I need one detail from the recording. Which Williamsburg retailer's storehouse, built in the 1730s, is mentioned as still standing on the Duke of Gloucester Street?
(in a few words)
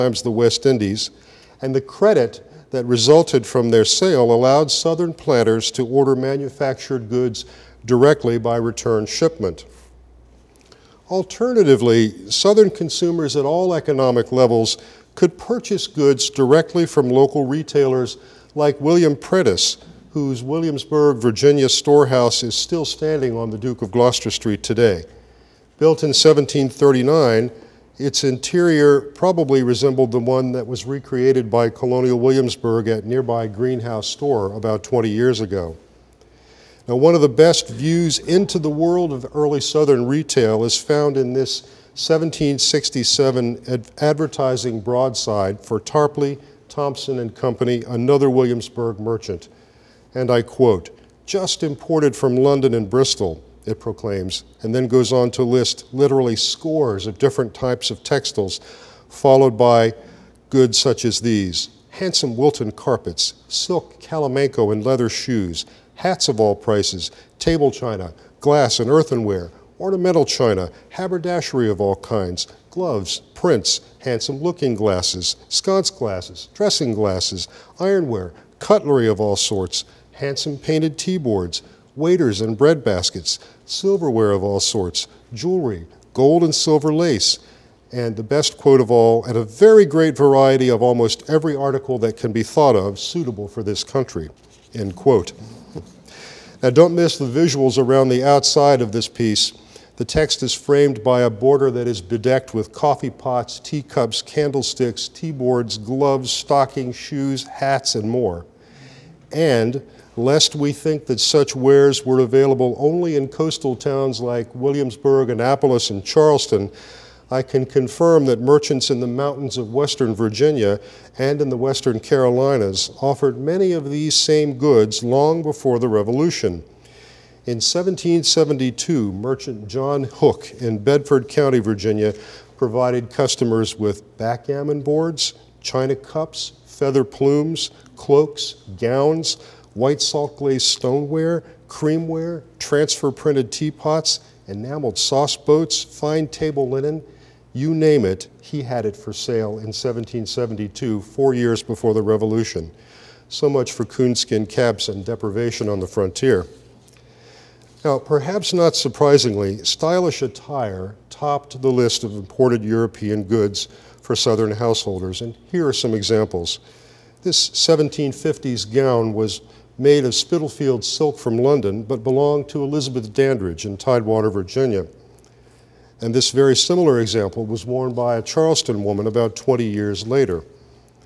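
William Prentis.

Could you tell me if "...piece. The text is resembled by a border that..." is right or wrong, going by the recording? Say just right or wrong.
wrong.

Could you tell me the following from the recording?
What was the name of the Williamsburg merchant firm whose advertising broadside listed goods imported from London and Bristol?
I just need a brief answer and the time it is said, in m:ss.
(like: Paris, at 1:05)
Tarpley, Thompson and Company, at 0:45.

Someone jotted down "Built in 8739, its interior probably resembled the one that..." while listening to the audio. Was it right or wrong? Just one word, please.
wrong.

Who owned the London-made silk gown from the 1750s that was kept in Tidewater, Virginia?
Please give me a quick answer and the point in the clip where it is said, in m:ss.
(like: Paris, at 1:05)
Elizabeth Dandridge, at 2:52.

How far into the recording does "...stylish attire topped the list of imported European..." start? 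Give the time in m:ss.
2:39.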